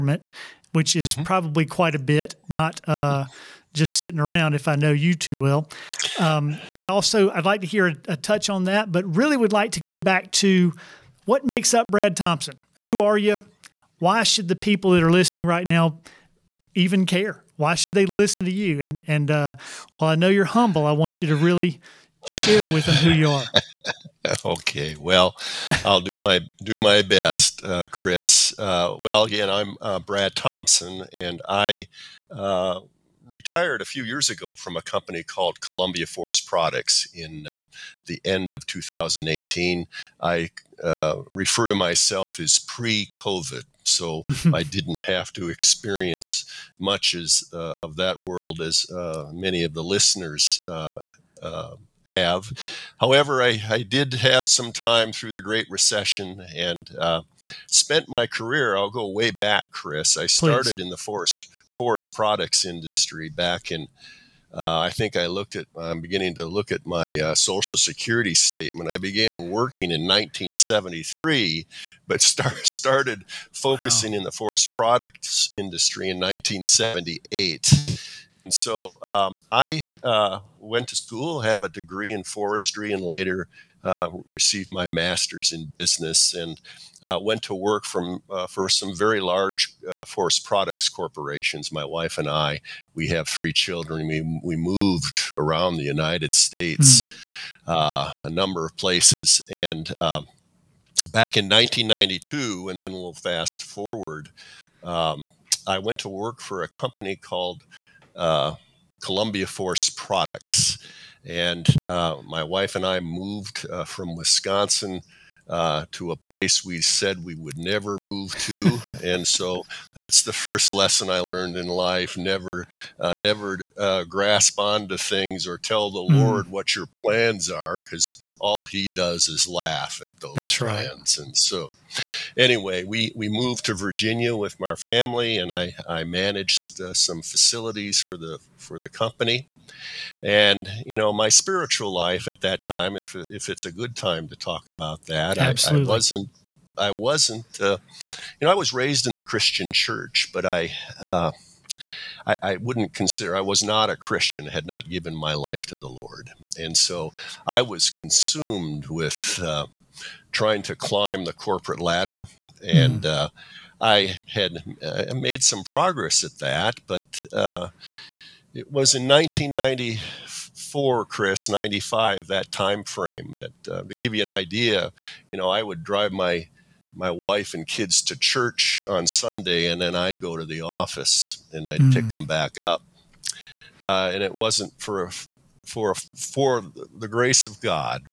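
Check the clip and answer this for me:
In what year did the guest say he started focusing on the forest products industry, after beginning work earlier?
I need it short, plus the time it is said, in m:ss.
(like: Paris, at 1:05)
1978, at 1:16.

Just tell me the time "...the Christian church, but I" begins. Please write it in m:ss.
2:29.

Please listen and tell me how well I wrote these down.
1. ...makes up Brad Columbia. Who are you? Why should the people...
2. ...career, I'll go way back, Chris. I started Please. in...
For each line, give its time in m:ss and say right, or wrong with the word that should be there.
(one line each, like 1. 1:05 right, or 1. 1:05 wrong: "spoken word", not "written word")
1. 0:11 wrong: "Thompson", not "Columbia"
2. 0:58 right.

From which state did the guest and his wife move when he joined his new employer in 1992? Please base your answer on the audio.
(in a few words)
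Wisconsin.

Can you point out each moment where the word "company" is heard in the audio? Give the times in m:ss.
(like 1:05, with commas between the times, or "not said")
0:34, 1:46, 2:18.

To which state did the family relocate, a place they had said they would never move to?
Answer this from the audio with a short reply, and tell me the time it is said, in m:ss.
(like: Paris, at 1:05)
Virginia, at 2:13.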